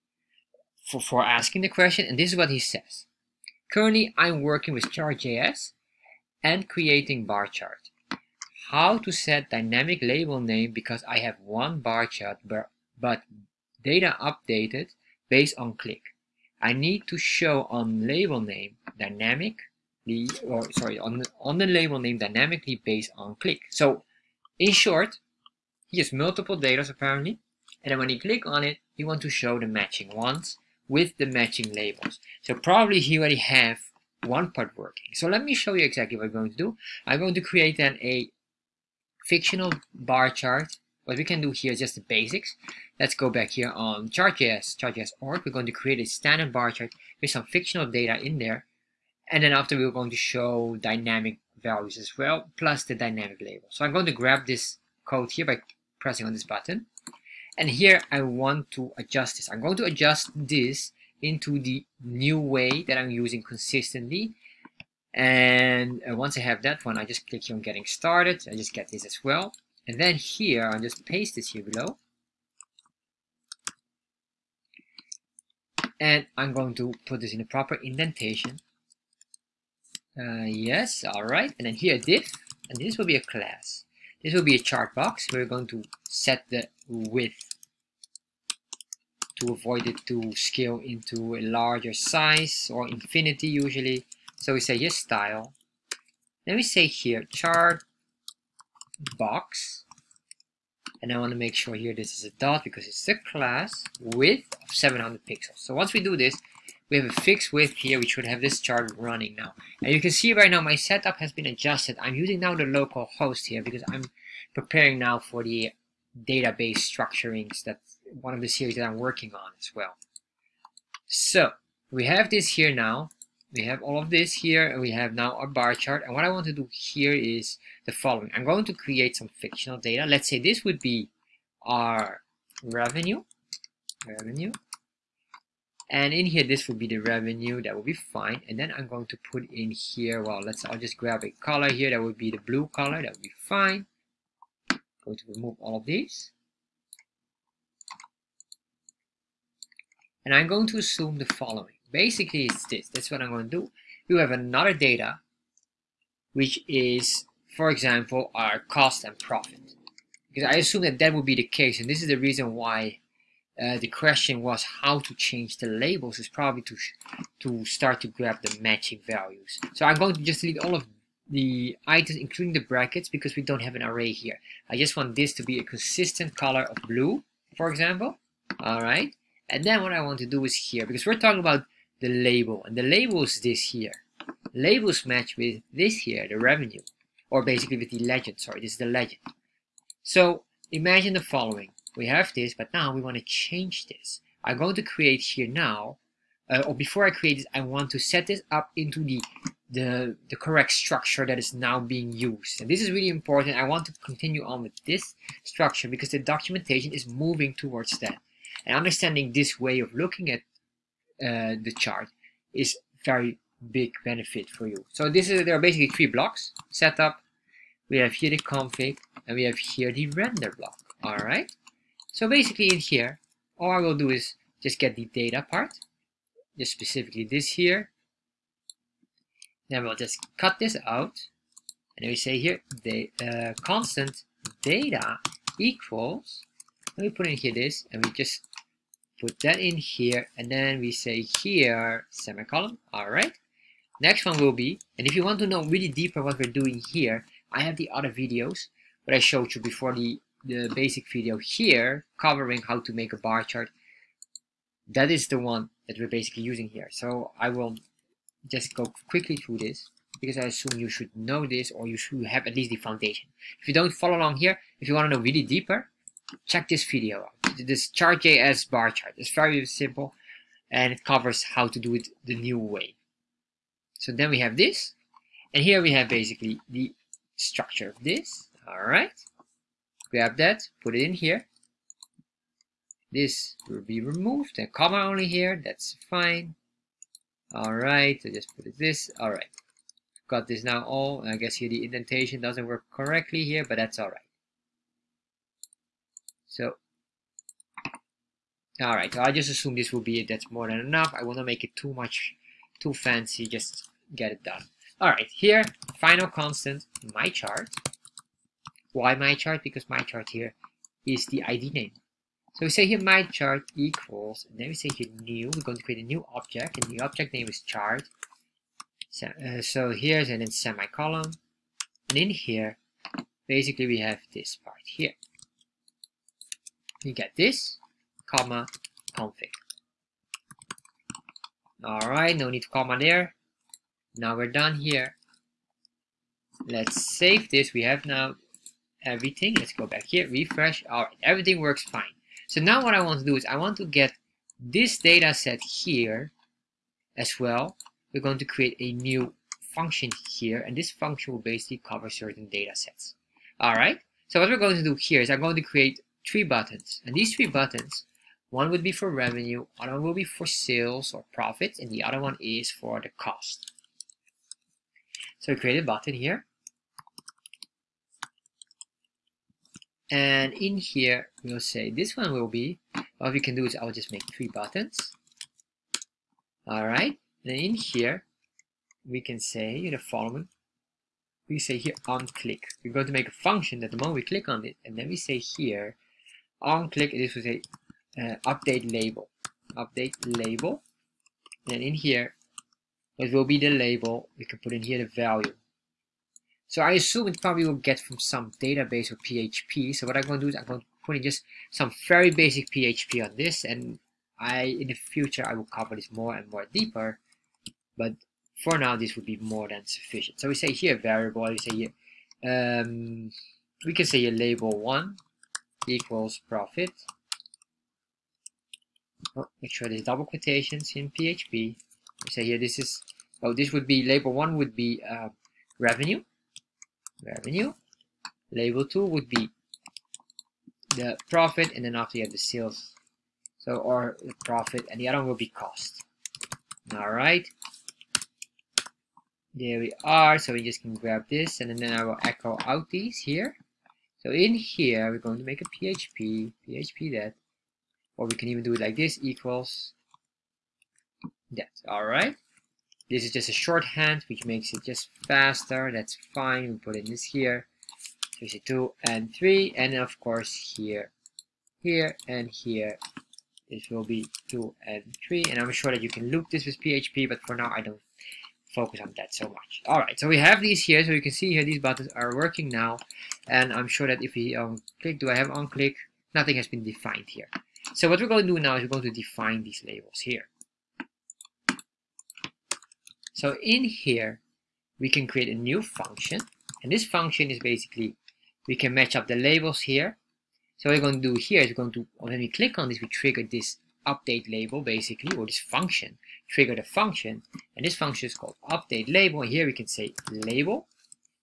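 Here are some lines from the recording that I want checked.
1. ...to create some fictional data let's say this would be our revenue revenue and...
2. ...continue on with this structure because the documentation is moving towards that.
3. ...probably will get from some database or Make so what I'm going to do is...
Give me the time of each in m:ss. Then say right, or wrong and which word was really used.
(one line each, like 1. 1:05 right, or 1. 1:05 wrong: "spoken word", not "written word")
1. 2:08 right
2. 3:24 right
3. 6:37 wrong: "PHP", not "Make".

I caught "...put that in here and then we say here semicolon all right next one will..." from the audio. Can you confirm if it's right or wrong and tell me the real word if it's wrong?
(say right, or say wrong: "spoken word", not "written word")
right.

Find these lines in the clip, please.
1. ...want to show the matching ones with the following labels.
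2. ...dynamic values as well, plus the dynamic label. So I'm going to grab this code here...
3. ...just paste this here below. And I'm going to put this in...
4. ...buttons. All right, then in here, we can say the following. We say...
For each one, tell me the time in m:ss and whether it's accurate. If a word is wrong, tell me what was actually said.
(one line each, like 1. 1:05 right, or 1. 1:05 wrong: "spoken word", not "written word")
1. 0:29 wrong: "matching", not "following"
2. 0:50 right
3. 1:10 right
4. 6:14 right.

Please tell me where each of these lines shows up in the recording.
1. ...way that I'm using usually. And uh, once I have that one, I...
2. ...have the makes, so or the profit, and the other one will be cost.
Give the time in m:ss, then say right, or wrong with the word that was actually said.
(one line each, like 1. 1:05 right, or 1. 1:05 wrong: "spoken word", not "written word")
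1. 1:02 wrong: "consistently", not "usually"
2. 7:12 wrong: "sales", not "makes".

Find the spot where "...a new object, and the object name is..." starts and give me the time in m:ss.
5:16.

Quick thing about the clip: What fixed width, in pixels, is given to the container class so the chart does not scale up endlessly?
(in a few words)
700.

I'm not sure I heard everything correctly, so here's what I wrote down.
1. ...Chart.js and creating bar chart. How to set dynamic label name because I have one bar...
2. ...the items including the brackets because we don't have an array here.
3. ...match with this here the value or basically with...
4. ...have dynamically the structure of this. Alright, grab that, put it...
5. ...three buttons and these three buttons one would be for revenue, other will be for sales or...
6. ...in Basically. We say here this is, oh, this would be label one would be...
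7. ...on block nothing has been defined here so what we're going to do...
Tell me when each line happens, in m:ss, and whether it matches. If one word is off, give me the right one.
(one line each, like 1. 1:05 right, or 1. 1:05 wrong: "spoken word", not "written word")
1. 0:04 right
2. 2:51 right
3. 3:05 wrong: "revenue", not "value"
4. 4:35 wrong: "basically", not "dynamically"
5. 5:56 right
6. 7:00 wrong: "PHP", not "Basically"
7. 7:55 wrong: "click", not "block".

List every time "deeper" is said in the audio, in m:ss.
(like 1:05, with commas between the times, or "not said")
4:05, 4:25, 6:46.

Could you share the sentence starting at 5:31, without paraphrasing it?
Alright, no need to comma there.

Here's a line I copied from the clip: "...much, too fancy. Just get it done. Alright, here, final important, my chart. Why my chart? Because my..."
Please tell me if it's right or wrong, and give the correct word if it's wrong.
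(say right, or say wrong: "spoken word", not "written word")
wrong: "constant", not "important".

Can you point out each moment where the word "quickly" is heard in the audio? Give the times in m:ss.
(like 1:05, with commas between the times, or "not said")
4:19.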